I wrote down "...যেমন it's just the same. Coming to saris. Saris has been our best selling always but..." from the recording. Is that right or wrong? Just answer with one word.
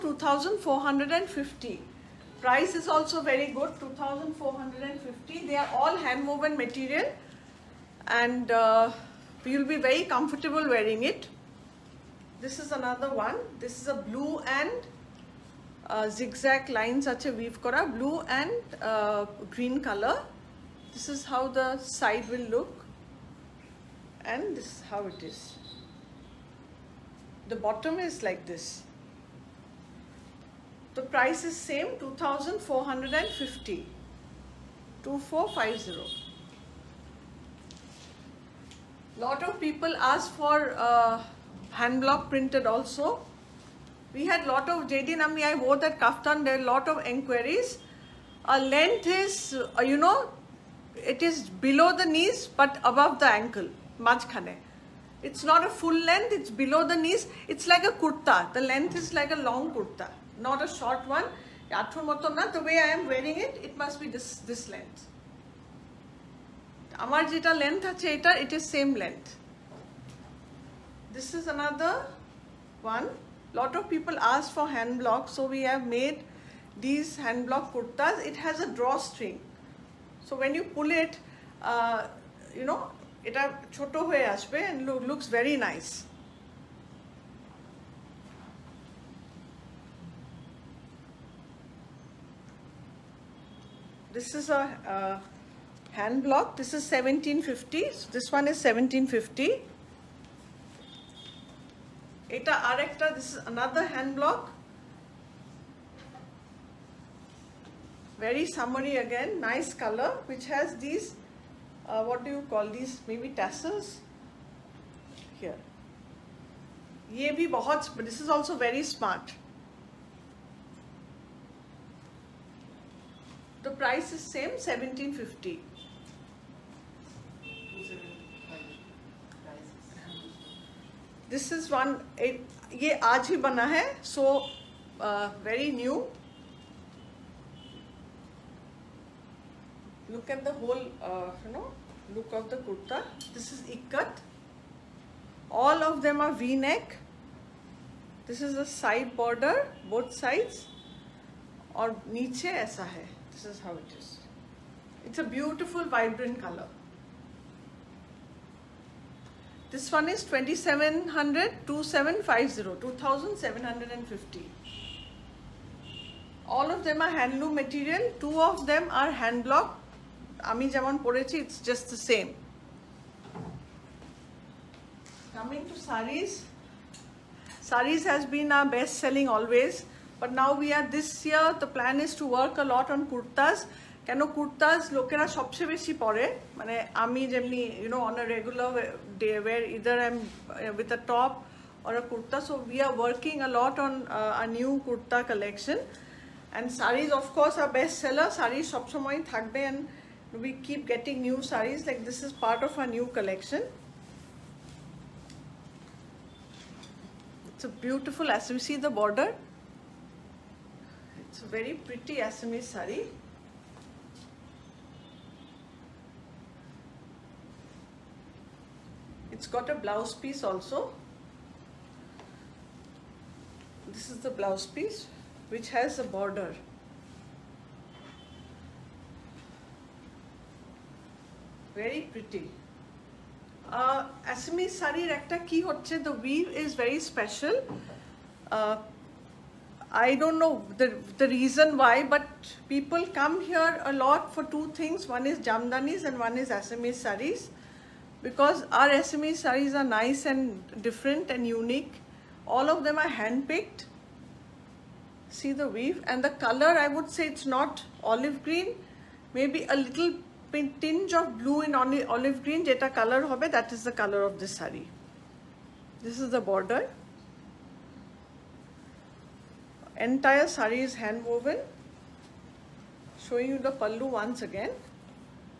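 right.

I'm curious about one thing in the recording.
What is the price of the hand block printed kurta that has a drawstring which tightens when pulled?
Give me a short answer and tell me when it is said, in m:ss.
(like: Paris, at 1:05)
1750, at 1:36.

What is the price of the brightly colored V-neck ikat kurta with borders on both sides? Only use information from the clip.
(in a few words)
2700.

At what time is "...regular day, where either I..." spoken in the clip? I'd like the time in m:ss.
3:08.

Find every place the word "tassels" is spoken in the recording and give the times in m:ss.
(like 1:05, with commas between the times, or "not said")
1:53.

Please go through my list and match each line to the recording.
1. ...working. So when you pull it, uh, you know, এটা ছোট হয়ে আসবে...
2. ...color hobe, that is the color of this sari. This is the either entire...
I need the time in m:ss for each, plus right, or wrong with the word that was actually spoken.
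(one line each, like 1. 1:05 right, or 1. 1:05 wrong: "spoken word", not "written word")
1. 1:18 wrong: "drawstring", not "working"
2. 4:22 wrong: "border", not "either".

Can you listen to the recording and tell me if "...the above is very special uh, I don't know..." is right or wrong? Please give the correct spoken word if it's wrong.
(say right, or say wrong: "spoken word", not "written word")
wrong: "weave", not "above".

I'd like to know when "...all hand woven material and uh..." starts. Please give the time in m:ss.
0:05.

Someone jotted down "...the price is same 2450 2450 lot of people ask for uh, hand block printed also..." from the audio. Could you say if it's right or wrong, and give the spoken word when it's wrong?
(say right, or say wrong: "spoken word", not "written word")
right.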